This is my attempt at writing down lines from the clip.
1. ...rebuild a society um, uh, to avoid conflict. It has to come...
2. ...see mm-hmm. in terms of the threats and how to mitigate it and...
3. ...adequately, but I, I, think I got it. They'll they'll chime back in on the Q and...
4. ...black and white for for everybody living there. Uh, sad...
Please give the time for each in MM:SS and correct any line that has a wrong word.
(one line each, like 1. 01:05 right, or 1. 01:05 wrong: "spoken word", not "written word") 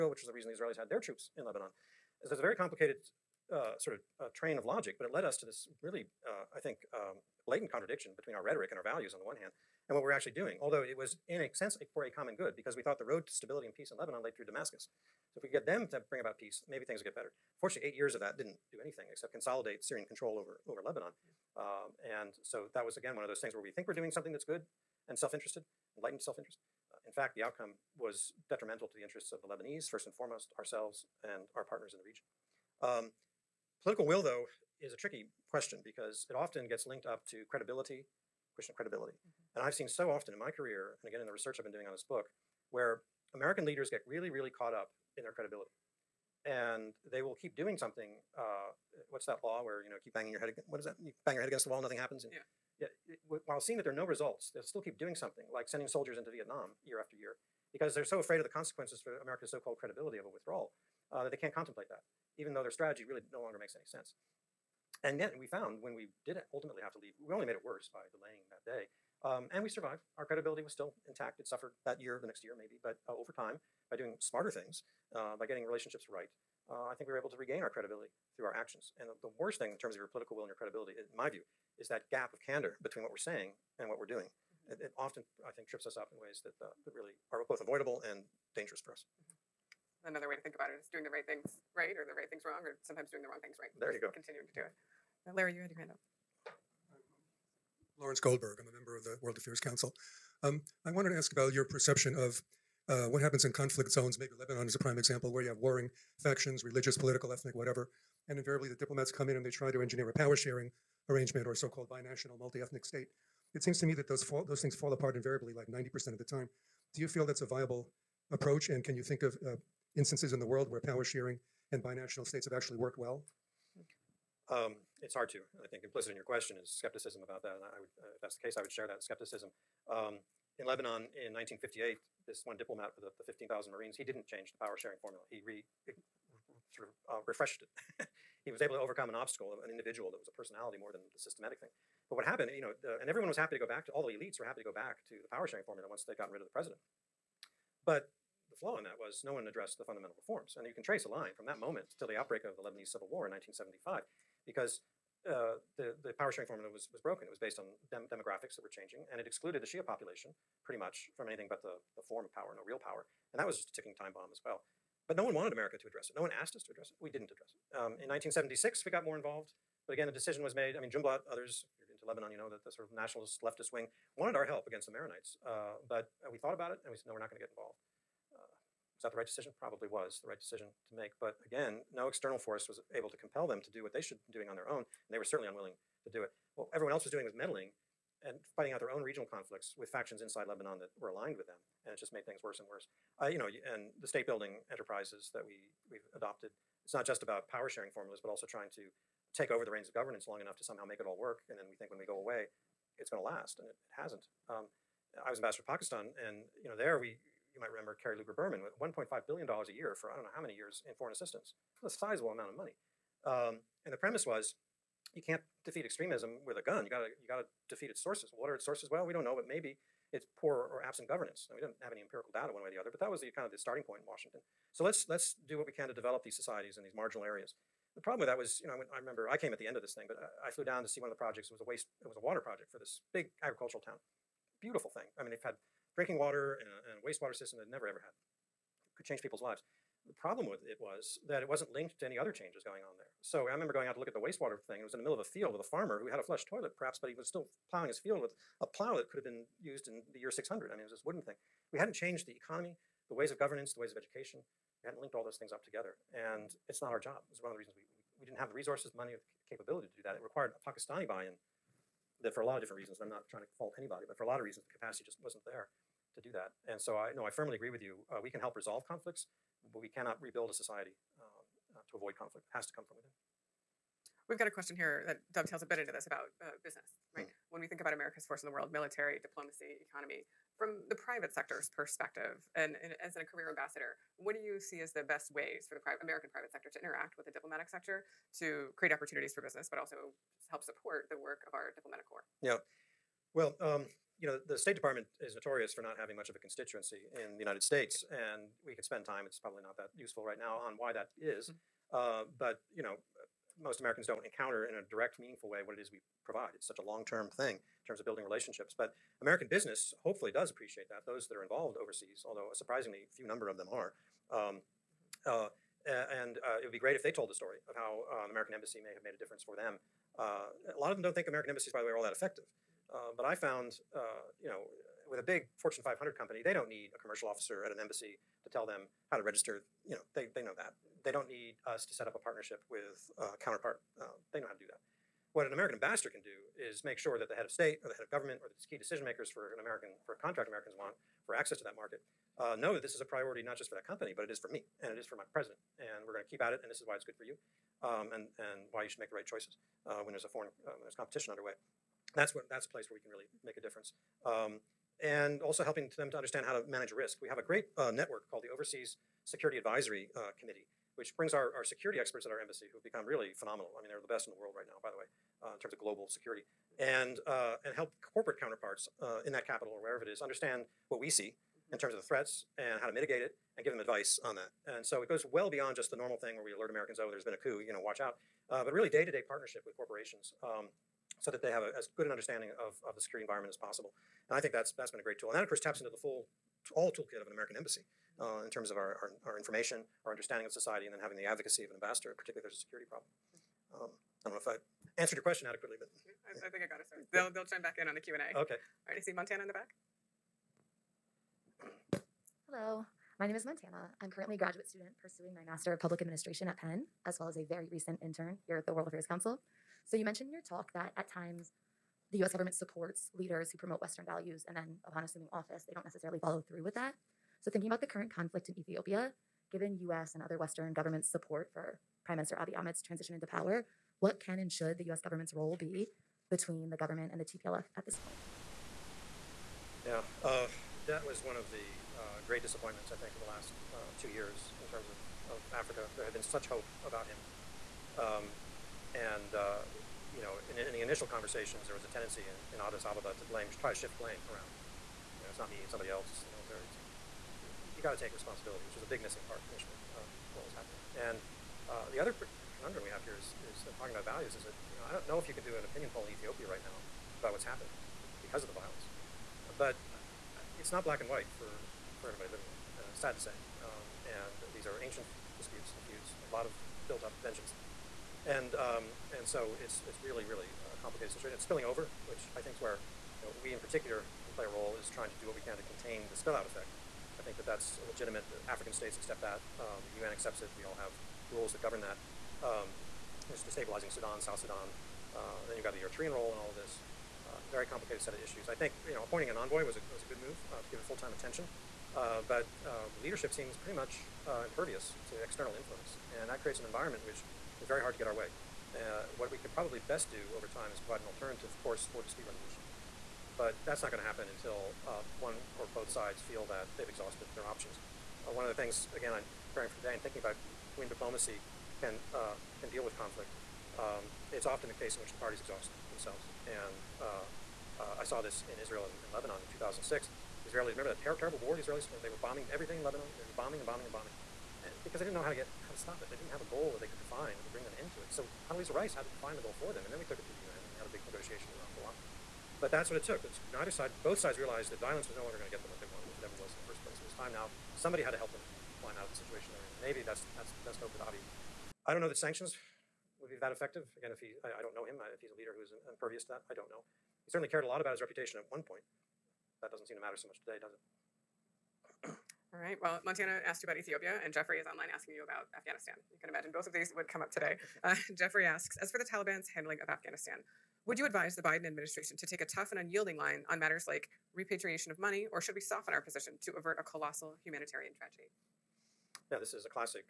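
1. 04:30 right
2. 06:11 right
3. 06:35 right
4. 07:40 right.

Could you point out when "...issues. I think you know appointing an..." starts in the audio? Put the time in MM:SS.
08:08.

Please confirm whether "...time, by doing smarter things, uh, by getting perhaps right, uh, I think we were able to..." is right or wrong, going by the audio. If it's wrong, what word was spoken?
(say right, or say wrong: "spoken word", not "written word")
wrong: "relationships", not "perhaps".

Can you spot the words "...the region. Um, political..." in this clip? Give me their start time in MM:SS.
00:31.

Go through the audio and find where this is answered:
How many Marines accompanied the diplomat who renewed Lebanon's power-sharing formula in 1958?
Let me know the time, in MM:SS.
02:13.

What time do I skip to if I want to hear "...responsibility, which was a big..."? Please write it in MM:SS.
07:28.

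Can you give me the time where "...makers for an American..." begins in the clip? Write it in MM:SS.
05:39.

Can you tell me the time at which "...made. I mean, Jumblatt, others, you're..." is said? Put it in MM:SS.
02:50.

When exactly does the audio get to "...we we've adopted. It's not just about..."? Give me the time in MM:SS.
03:15.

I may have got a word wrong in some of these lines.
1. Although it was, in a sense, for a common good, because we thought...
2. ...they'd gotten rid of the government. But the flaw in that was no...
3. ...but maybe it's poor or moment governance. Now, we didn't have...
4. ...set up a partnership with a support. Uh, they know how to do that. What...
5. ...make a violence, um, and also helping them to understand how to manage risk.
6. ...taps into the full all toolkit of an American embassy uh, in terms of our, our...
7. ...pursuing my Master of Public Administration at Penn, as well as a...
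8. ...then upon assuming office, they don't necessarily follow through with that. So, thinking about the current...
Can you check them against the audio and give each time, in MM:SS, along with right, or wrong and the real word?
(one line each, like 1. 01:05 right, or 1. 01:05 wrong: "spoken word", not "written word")
1. 00:10 right
2. 02:26 wrong: "president", not "government"
3. 03:39 wrong: "absent", not "moment"
4. 05:31 wrong: "counterpart", not "support"
5. 05:53 wrong: "difference", not "violence"
6. 06:25 right
7. 06:45 right
8. 06:54 right.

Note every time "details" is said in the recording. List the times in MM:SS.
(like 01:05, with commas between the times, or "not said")
not said.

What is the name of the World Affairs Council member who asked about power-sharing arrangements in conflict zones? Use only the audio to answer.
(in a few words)
Lawrence Goldberg.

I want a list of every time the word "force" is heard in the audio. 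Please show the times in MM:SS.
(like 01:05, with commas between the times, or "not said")
03:02, 04:38.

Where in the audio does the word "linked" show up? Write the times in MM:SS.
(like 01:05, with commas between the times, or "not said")
00:36, 04:01, 04:15.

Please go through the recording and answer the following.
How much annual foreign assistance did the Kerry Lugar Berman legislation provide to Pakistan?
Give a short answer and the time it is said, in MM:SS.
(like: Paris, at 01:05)
1.5 billion dollars, at 03:28.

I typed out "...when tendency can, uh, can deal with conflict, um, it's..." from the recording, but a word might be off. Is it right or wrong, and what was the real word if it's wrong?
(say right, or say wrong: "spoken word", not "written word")
wrong: "diplomacy", not "tendency".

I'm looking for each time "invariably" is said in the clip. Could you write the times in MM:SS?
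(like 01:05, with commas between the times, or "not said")
01:48, 01:55.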